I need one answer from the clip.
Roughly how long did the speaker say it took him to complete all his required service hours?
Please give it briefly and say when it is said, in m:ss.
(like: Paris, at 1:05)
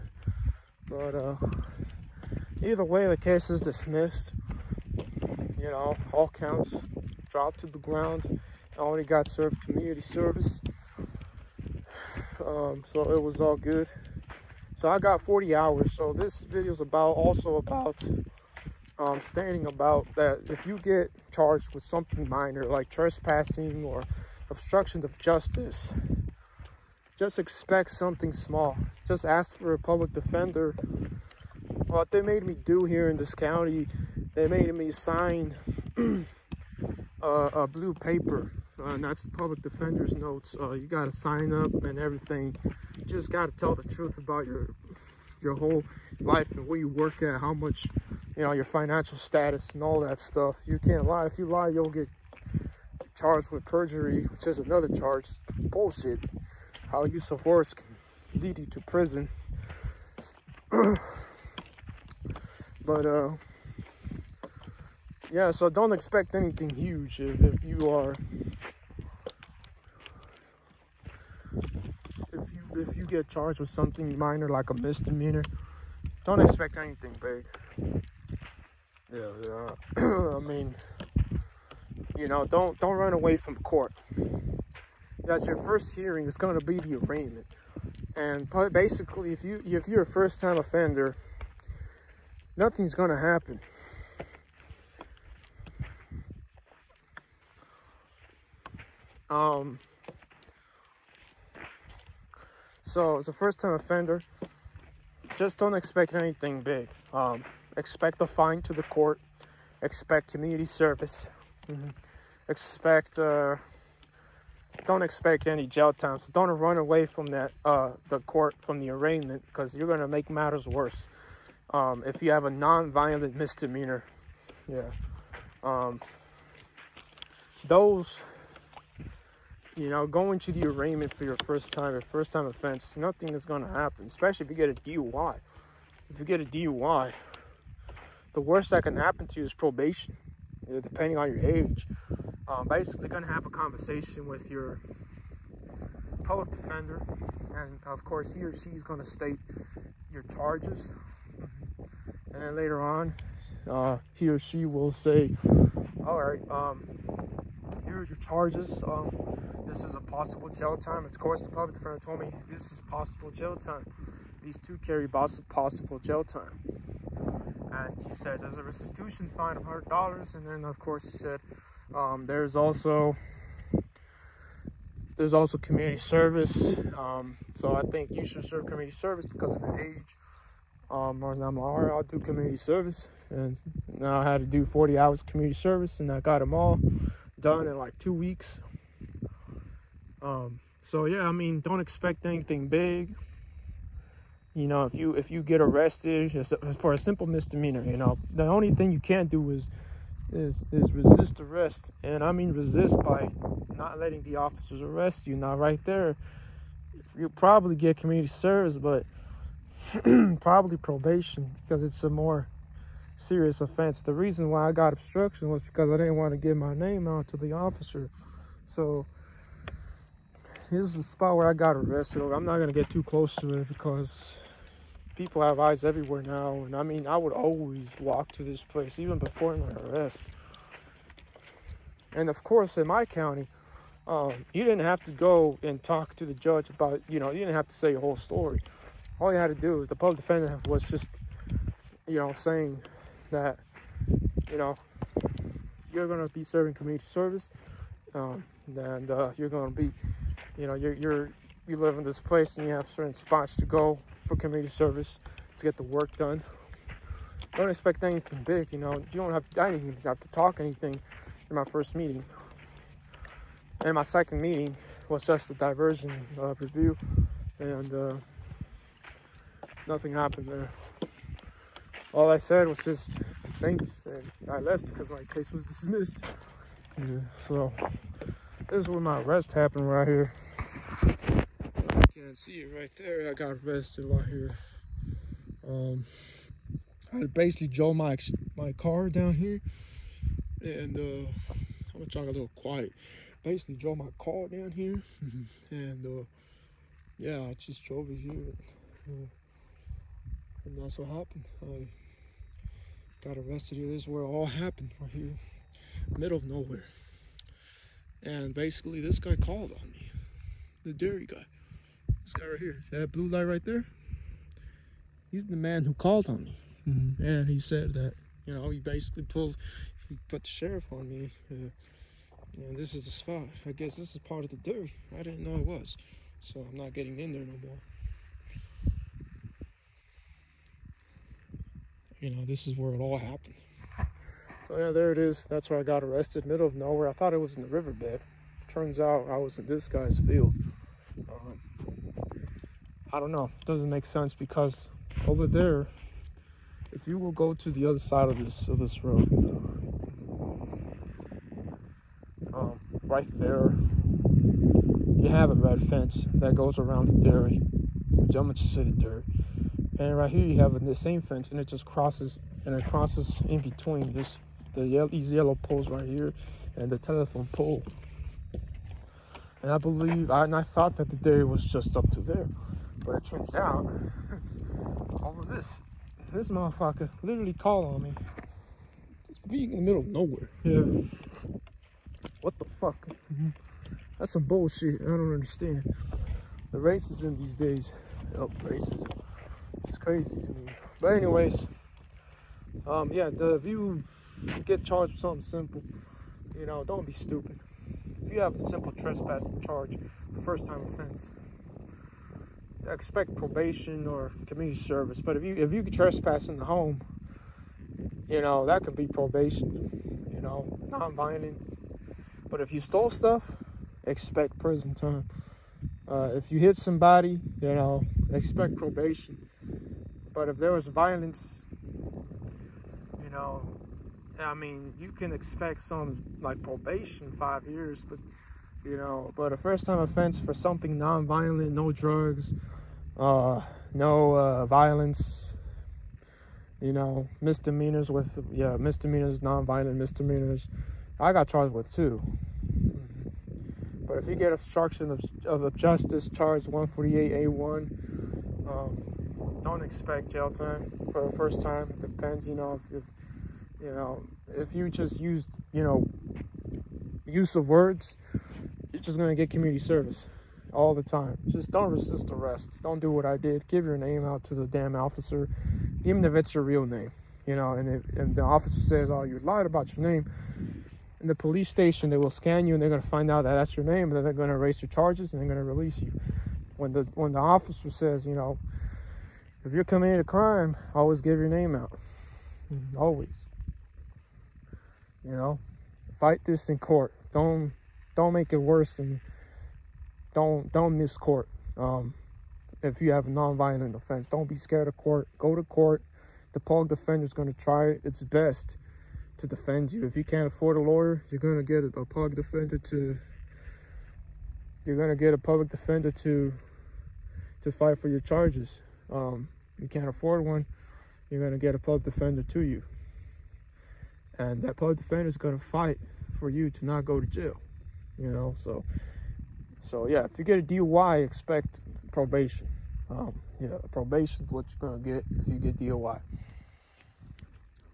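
Two weeks, at 3:07.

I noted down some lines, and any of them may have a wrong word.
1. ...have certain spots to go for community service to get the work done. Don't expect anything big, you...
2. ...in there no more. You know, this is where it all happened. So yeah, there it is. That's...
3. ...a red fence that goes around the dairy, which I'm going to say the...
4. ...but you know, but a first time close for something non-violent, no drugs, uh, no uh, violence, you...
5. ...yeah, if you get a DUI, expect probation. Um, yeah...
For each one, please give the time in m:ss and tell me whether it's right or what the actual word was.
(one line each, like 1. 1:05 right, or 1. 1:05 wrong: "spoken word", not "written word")
1. 4:12 right
2. 5:27 right
3. 5:55 right
4. 7:08 wrong: "offense", not "close"
5. 8:40 right.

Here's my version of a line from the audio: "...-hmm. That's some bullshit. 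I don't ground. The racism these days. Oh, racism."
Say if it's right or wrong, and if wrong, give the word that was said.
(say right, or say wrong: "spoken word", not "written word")
wrong: "understand", not "ground".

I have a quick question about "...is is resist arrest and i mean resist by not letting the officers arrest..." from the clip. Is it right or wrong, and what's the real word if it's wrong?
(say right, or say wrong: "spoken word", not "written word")
right.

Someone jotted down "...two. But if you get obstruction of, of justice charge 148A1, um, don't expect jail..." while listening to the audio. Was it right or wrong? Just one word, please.
right.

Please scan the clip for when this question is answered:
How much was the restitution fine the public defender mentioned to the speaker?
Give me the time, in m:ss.
2:49.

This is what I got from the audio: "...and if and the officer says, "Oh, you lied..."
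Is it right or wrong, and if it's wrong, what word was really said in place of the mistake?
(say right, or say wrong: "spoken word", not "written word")
right.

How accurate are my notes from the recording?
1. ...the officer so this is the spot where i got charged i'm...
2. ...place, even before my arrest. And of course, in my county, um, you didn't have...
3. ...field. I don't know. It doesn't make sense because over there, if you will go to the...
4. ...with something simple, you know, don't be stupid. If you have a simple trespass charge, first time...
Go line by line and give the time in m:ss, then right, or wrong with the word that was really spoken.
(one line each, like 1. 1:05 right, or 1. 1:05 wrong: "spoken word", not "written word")
1. 3:37 wrong: "arrested", not "charged"
2. 3:48 right
3. 5:40 right
4. 6:35 right.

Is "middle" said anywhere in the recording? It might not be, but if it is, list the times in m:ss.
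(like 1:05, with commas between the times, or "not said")
5:06, 5:36, 6:19.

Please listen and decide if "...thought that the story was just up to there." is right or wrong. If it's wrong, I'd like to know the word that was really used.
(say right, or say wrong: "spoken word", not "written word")
wrong: "dairy", not "story".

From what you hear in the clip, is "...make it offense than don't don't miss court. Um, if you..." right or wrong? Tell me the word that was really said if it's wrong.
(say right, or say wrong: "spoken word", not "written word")
wrong: "worse", not "offense".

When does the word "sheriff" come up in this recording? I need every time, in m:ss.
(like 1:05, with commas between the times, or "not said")
5:20.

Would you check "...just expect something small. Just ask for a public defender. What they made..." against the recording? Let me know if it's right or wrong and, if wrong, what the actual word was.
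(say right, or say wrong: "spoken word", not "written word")
right.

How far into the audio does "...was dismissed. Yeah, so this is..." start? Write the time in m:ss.
4:35.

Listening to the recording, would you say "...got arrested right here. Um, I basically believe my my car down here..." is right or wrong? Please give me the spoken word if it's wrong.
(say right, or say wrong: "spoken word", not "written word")
wrong: "drove", not "believe".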